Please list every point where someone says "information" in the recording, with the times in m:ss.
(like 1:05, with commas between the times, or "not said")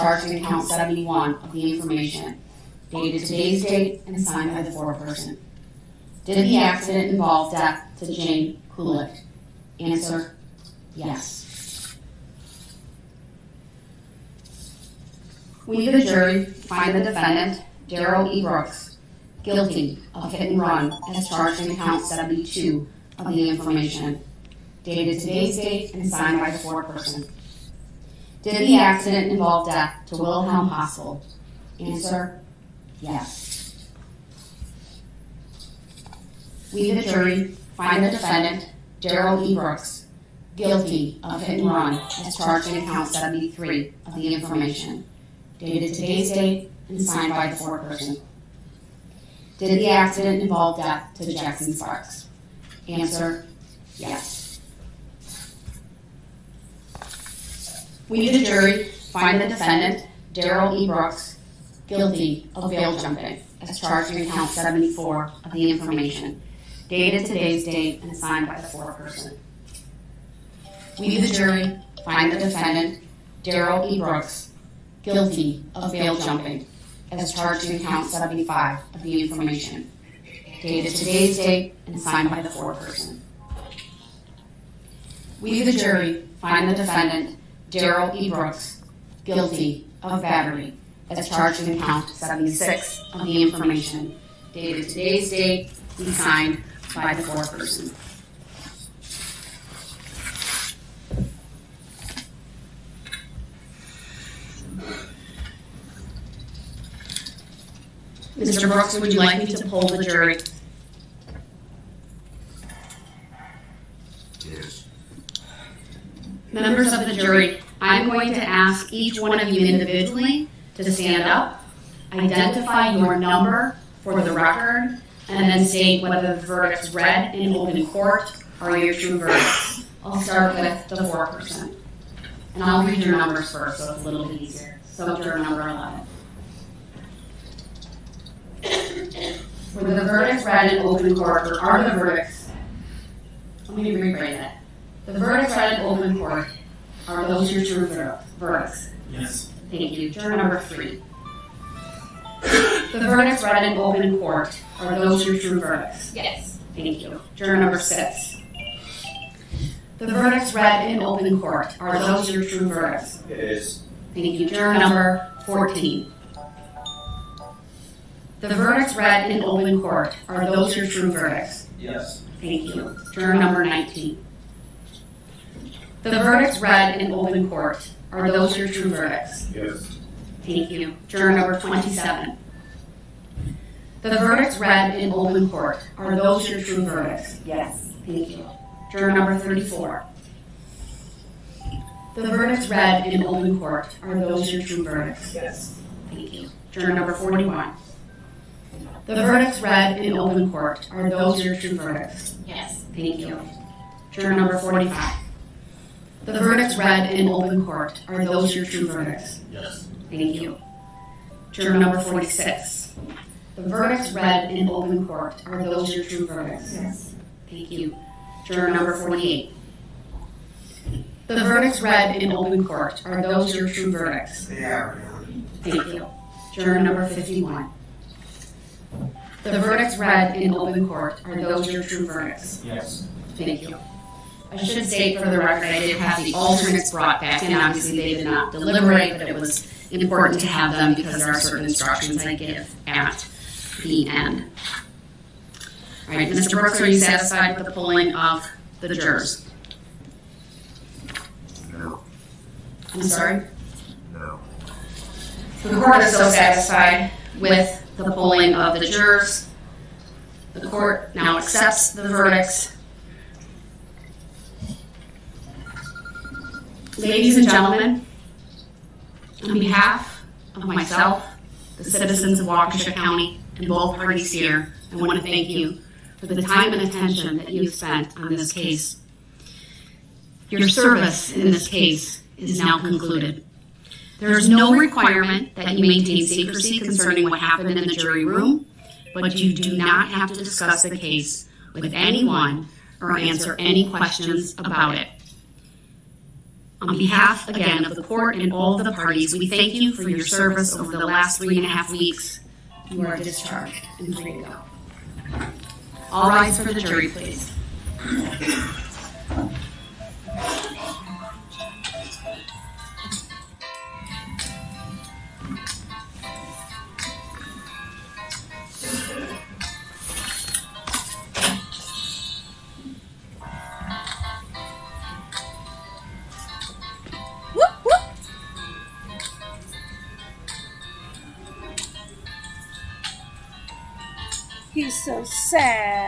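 0:01, 0:23, 0:44, 1:05, 1:19, 1:33.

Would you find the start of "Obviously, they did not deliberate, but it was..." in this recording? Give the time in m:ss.
3:57.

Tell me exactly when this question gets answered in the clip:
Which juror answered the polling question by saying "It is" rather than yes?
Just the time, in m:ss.
2:37.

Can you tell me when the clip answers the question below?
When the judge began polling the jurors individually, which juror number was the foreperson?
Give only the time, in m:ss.
2:15.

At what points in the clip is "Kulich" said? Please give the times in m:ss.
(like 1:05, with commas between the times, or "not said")
0:08.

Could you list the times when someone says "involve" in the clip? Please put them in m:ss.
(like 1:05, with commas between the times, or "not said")
0:07, 0:29, 0:50.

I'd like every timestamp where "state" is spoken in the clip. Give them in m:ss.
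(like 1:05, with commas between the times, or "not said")
2:05, 3:54.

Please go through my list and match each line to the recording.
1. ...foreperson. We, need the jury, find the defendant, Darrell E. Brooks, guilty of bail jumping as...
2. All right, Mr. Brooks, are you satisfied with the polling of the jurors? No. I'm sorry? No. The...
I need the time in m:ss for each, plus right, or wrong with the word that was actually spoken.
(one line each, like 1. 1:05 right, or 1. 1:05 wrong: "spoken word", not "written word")
1. 1:08 right
2. 4:06 right.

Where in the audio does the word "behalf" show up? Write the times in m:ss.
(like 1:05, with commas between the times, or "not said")
4:29, 4:56.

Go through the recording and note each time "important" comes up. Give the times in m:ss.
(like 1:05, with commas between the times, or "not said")
3:59.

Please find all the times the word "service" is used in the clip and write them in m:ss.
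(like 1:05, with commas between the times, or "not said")
4:40, 5:00.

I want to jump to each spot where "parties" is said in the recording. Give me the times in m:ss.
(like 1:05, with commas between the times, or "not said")
4:33, 4:58.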